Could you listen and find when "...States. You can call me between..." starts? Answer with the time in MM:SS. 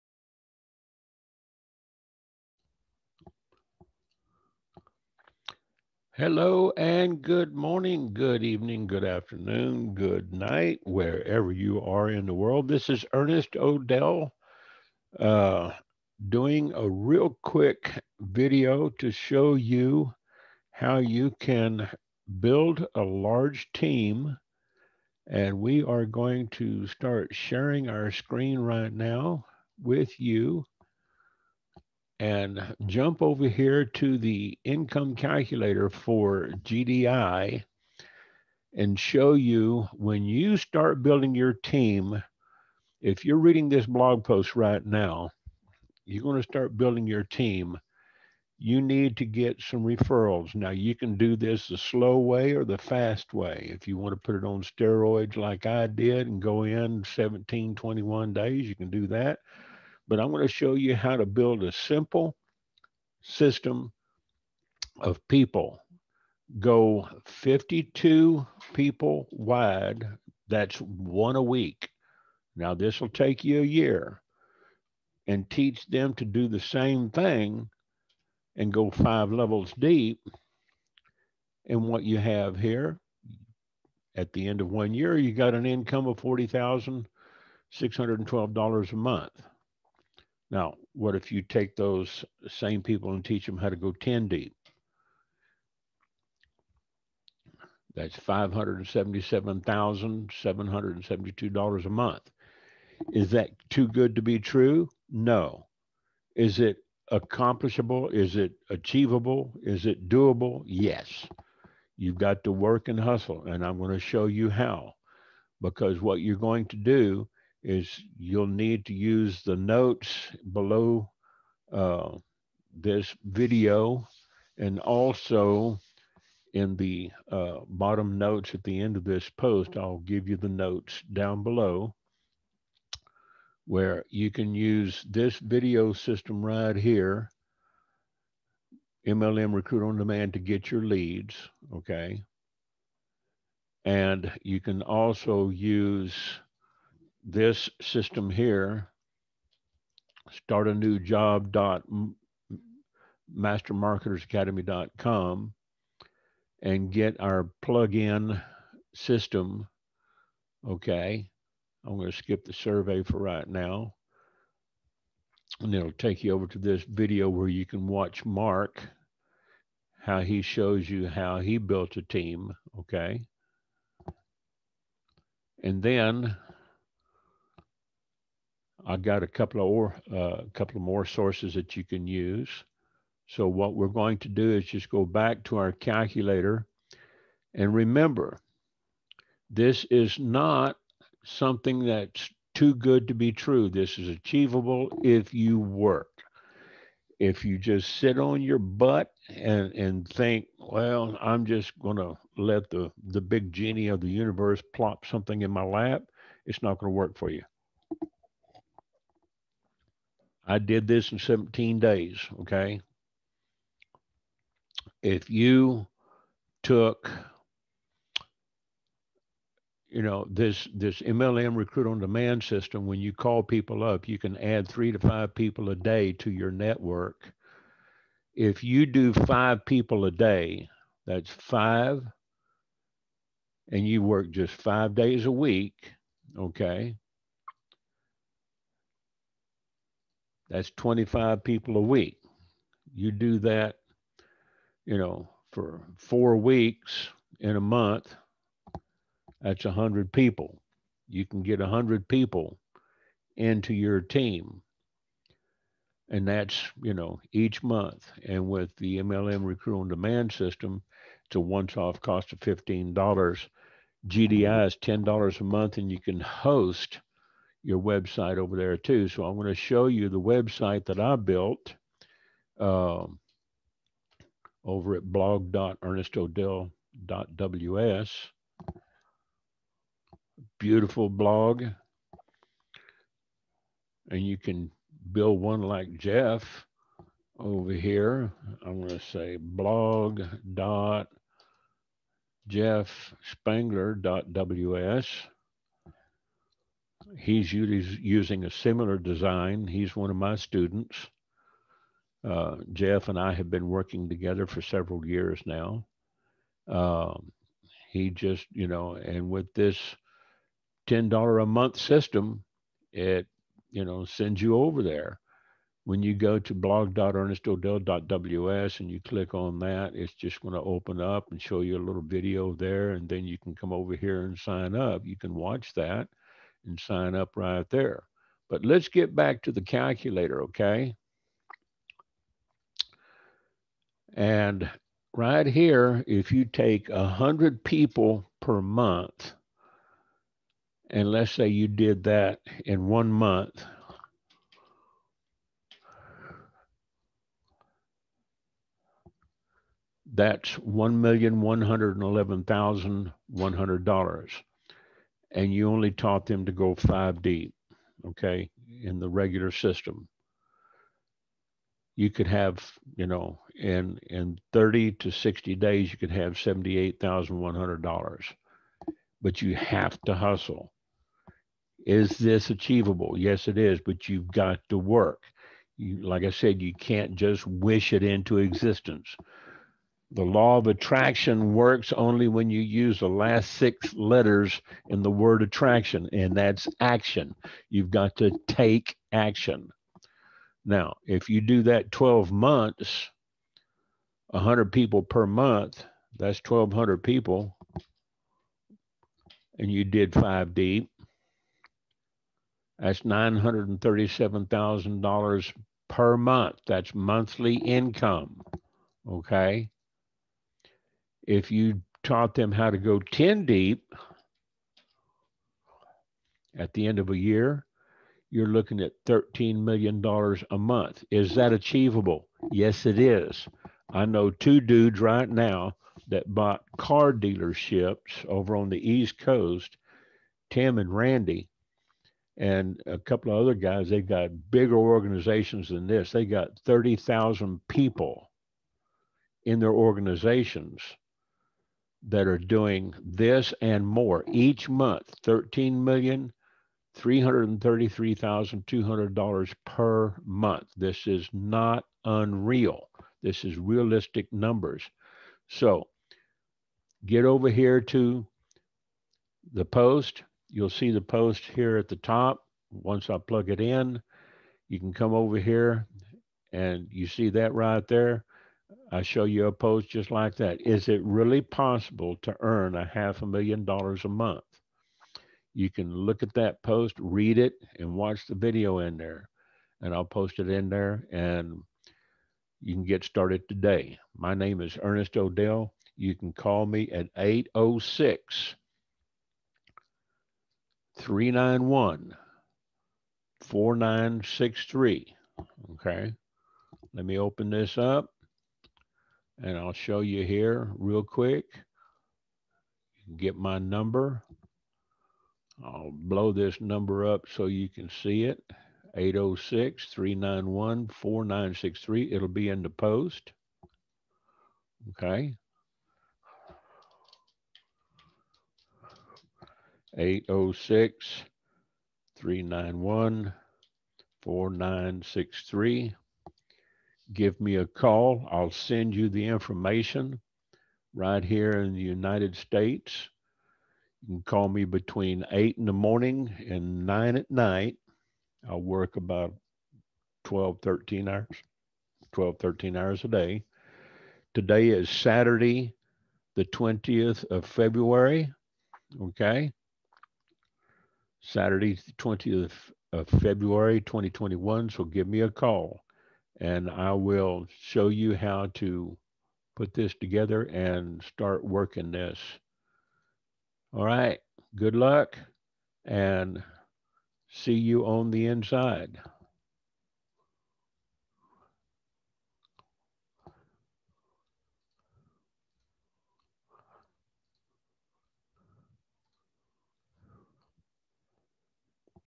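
08:52.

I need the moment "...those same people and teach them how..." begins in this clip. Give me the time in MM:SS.
01:31.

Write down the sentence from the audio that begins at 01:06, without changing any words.
Go 52 people wide, that's one a week.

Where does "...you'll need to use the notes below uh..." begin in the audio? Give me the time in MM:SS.
01:58.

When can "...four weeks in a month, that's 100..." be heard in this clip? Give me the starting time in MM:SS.
04:05.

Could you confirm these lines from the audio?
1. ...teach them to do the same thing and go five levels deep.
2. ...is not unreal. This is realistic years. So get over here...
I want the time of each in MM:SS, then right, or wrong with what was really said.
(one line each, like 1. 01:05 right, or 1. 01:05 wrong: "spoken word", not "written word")
1. 01:15 right
2. 07:31 wrong: "numbers", not "years".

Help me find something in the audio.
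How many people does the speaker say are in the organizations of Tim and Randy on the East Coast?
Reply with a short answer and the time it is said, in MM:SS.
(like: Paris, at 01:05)
30,000, at 07:16.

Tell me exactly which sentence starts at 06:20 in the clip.
The law of attraction works only when you use the last six letters in the word attraction, and that's action.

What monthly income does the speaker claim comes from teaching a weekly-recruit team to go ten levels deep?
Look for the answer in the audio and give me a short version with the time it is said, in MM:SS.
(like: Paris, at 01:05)
$577,772, at 01:38.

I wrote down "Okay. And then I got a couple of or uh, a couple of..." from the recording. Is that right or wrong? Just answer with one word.
right.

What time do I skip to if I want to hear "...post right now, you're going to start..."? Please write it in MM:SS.
00:44.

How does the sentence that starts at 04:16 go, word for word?
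And that's, you know, each month.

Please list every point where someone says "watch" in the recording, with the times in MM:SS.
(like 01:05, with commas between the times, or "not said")
02:47, 05:25, 07:57.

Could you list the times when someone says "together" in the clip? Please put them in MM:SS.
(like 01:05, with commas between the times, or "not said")
05:04, 09:19.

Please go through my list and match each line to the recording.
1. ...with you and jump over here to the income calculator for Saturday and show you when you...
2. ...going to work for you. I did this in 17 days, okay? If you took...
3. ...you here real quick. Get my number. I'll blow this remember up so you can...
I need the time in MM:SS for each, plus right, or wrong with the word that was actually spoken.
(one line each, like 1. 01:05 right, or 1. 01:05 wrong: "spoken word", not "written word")
1. 00:29 wrong: "GDI", not "Saturday"
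2. 03:26 right
3. 08:20 wrong: "number", not "remember".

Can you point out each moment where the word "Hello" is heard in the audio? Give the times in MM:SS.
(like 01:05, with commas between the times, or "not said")
00:06.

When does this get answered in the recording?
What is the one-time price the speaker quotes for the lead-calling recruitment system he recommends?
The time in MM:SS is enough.
04:22.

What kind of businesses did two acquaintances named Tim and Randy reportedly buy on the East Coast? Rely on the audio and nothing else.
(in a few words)
car dealerships.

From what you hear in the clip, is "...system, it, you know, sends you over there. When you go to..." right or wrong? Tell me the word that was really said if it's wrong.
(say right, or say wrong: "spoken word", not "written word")
right.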